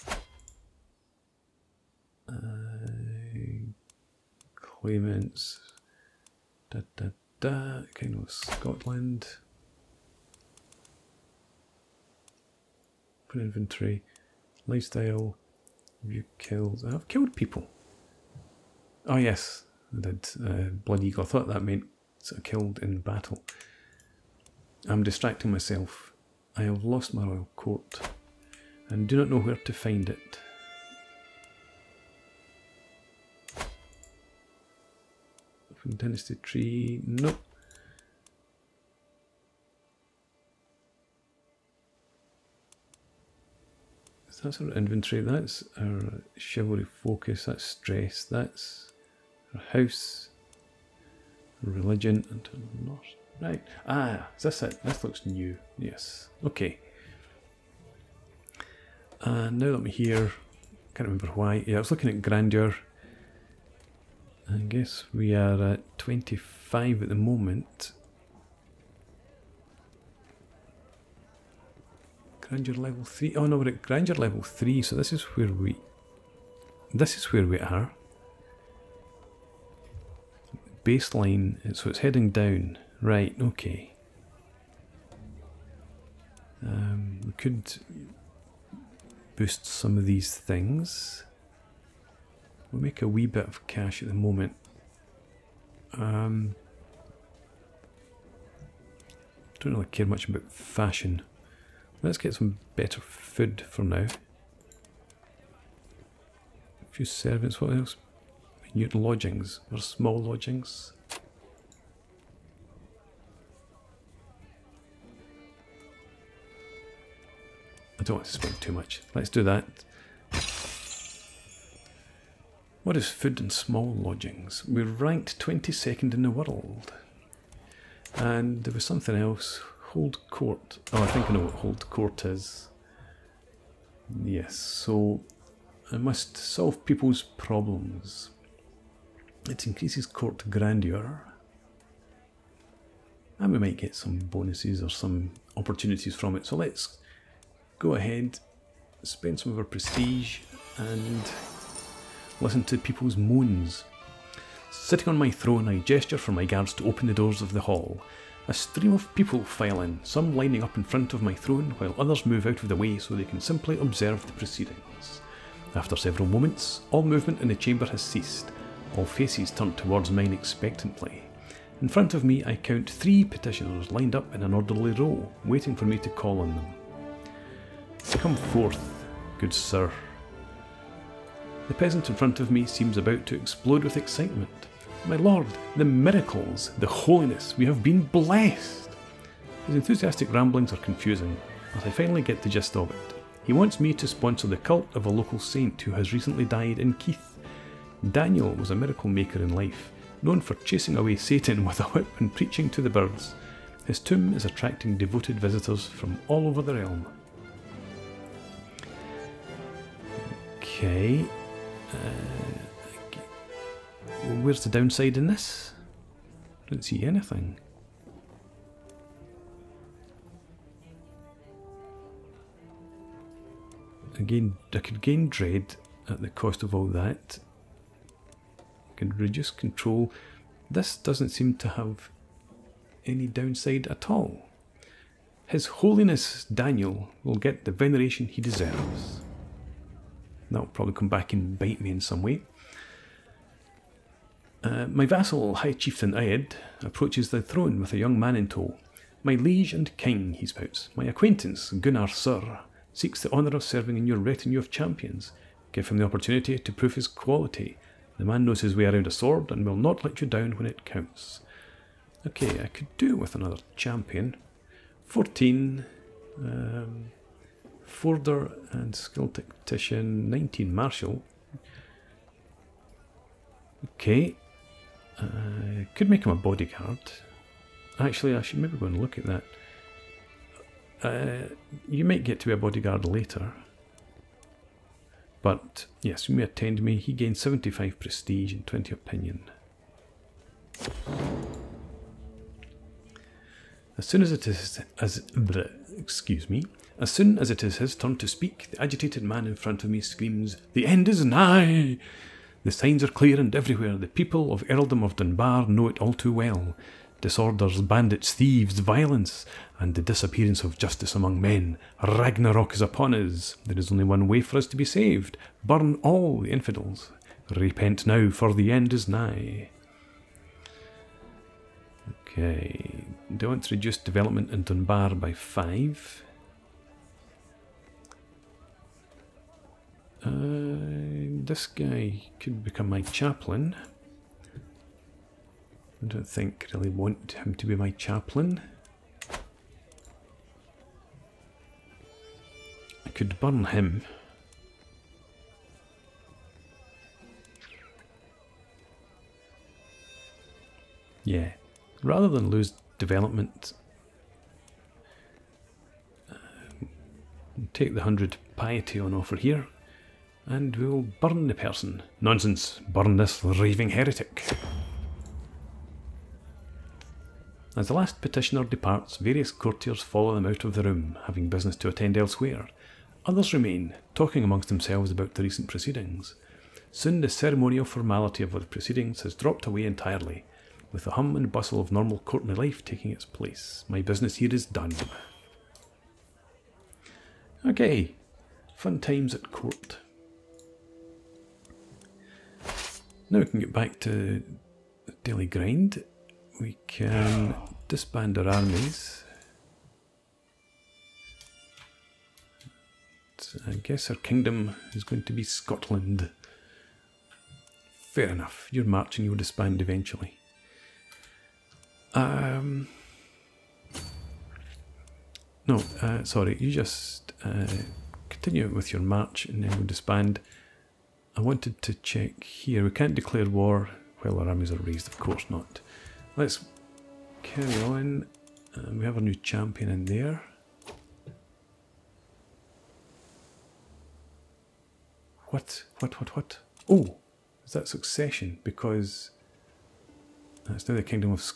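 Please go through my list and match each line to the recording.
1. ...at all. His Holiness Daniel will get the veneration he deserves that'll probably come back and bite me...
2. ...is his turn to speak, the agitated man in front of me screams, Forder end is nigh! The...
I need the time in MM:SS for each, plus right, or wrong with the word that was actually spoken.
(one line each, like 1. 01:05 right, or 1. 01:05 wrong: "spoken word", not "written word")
1. 03:53 right
2. 04:57 wrong: "The", not "Forder".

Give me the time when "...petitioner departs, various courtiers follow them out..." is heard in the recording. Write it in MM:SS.
06:08.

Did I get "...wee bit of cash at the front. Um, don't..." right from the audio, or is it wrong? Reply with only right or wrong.
wrong.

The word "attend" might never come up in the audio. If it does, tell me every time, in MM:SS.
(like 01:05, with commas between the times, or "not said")
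04:46, 06:11.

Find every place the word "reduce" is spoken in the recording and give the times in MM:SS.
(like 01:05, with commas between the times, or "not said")
03:49, 05:23.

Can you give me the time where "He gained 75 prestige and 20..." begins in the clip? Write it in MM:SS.
04:46.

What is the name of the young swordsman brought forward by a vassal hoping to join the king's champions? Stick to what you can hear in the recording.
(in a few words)
Gunnar Sir.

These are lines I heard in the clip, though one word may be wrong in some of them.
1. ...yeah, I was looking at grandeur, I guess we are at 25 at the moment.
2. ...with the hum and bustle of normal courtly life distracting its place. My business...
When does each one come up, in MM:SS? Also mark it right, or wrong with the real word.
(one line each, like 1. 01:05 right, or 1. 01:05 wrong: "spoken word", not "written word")
1. 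01:01 right
2. 06:20 wrong: "taking", not "distracting".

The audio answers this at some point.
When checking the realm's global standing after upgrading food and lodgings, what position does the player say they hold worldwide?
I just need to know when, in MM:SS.
02:05.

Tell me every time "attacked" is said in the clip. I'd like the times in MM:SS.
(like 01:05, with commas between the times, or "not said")
not said.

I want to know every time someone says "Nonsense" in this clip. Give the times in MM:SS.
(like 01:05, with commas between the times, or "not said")
06:02.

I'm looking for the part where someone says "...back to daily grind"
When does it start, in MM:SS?
06:33.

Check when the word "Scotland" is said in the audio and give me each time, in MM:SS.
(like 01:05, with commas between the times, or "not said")
00:08, 06:45.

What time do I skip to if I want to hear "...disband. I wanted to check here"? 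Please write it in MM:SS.
06:59.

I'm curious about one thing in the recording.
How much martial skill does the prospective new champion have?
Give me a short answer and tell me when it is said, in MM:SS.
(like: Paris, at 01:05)
19, at 04:30.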